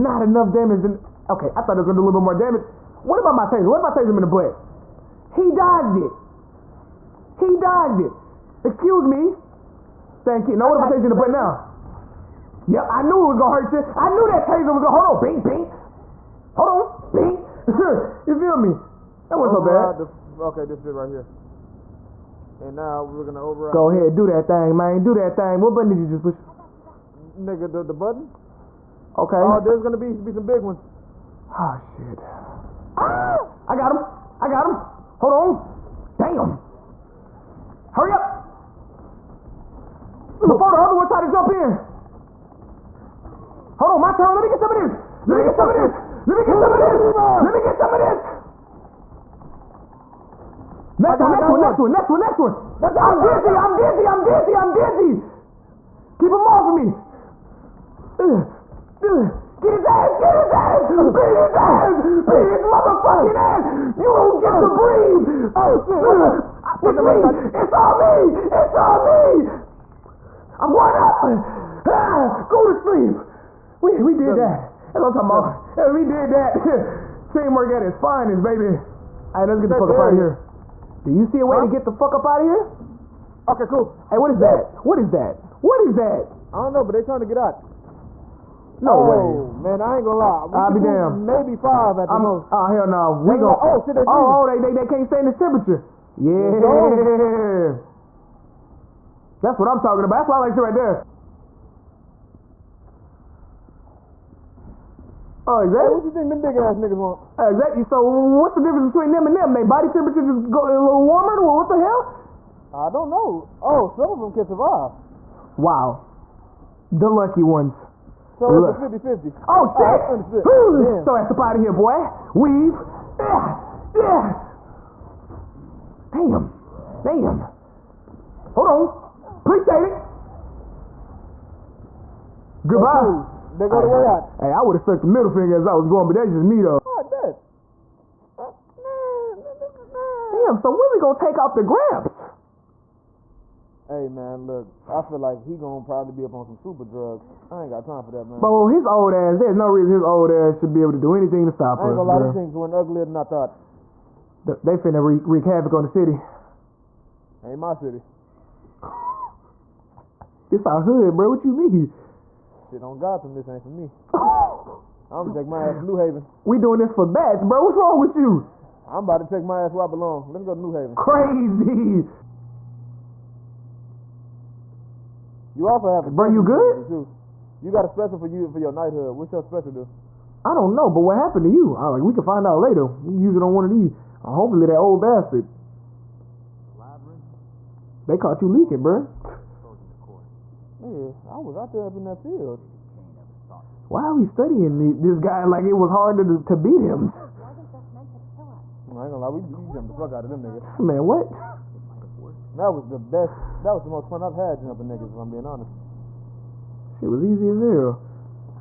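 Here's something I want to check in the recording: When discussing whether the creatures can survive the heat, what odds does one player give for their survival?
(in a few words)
50-50.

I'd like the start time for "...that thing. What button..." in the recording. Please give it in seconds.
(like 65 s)
25 s.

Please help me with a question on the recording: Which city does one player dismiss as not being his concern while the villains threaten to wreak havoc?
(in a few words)
Gotham.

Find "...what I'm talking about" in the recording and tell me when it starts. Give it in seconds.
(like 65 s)
99 s.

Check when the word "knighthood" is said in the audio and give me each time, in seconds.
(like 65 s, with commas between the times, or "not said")
178 s.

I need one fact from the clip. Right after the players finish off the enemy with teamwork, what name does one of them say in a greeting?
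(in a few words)
Tamar.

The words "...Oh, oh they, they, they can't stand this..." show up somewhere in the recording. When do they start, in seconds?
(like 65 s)
94 s.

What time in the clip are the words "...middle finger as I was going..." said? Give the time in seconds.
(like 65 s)
135 s.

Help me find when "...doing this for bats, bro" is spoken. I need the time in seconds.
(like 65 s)
166 s.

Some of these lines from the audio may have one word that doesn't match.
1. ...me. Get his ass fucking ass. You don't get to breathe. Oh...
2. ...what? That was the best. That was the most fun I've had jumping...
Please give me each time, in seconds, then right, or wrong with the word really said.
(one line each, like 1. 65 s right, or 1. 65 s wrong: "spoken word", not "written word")
1. 56 s right
2. 201 s right.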